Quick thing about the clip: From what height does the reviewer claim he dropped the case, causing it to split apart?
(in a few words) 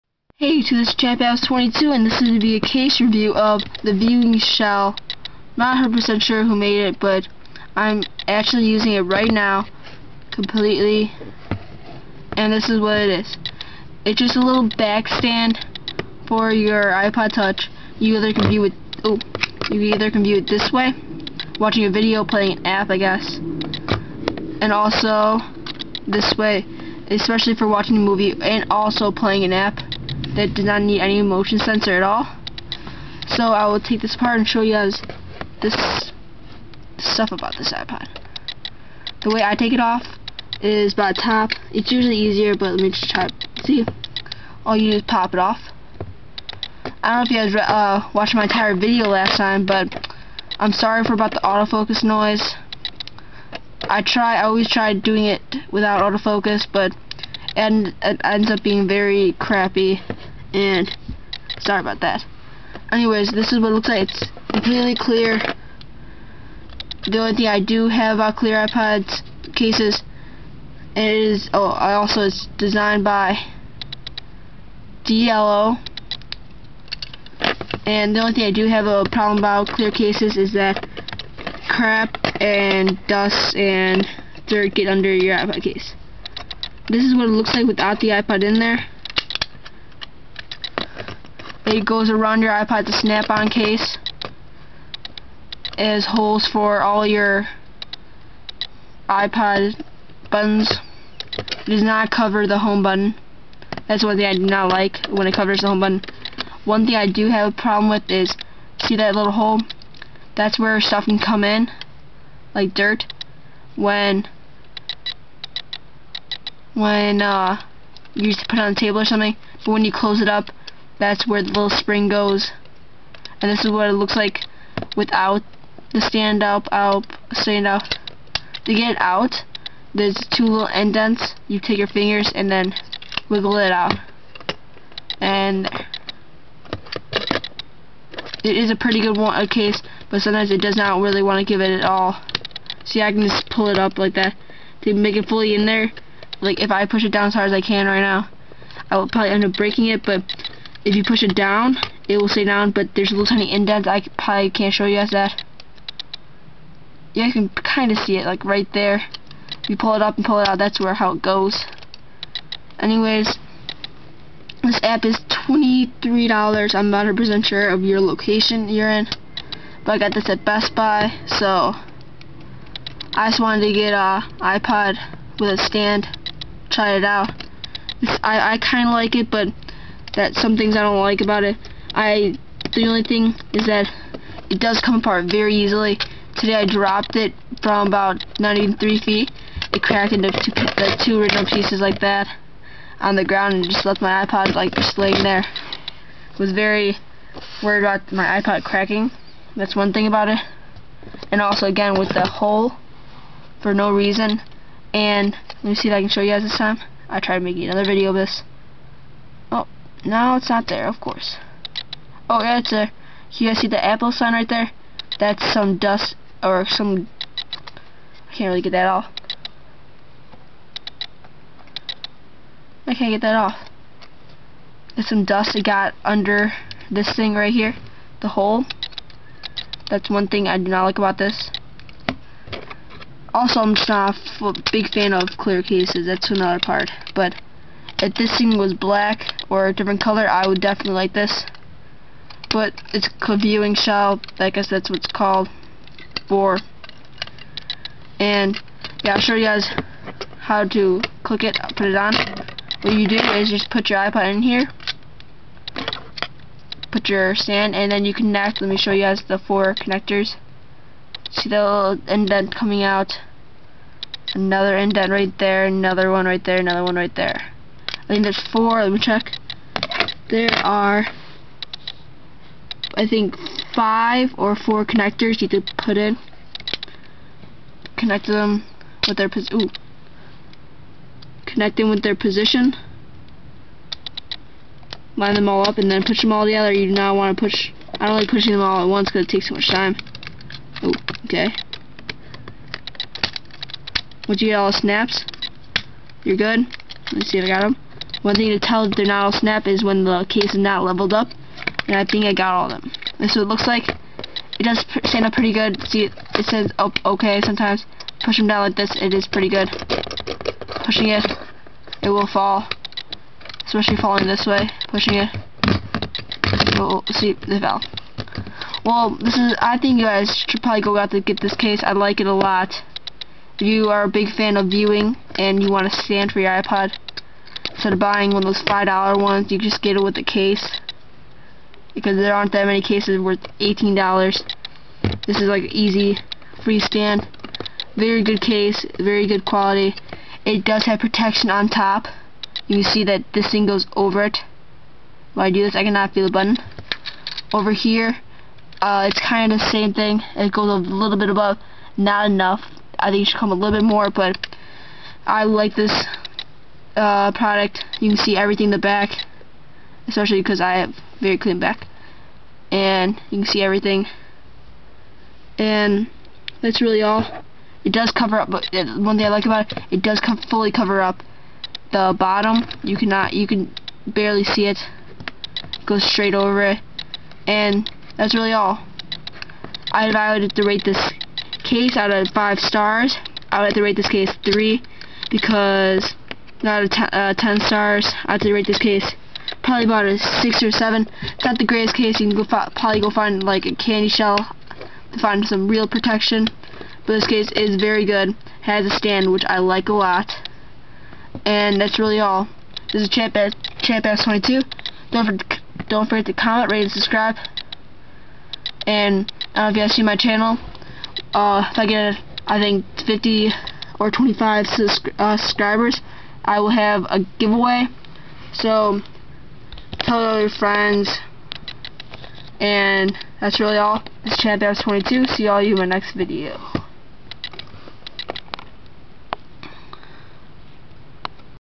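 93 feet.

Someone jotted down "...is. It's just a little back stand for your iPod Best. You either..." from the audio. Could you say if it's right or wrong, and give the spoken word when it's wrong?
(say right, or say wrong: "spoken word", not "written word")
wrong: "Touch", not "Best".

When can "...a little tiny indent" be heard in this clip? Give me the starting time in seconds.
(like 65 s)
153 s.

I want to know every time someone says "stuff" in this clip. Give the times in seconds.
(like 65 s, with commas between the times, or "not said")
36 s, 110 s.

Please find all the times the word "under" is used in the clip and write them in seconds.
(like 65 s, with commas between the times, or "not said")
84 s, 226 s.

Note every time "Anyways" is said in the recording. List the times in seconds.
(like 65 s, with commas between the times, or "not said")
62 s, 162 s.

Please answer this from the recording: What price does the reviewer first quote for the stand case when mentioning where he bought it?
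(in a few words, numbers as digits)
$23.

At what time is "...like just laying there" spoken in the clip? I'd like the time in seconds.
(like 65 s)
194 s.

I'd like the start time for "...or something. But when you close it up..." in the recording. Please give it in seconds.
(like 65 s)
119 s.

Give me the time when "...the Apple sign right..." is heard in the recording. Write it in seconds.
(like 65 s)
213 s.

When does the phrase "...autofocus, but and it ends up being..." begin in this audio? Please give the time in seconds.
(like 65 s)
56 s.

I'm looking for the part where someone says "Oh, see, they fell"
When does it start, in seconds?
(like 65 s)
316 s.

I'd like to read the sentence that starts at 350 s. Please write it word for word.
It goes a little bit above, not enough.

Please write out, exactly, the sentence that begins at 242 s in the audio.
But it's a VideoShell, I guess that's what it's called, for.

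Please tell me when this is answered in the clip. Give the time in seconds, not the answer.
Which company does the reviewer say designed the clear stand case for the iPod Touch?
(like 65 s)
75 s.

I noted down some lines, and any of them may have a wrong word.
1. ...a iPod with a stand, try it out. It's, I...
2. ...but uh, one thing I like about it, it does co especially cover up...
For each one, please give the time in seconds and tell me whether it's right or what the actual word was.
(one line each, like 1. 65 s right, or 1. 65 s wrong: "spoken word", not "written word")
1. 173 s right
2. 368 s wrong: "fully", not "especially".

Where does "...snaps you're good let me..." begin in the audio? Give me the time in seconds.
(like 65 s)
294 s.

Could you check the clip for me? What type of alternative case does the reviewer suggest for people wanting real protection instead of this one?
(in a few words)
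candy shell.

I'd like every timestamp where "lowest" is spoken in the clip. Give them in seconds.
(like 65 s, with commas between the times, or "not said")
not said.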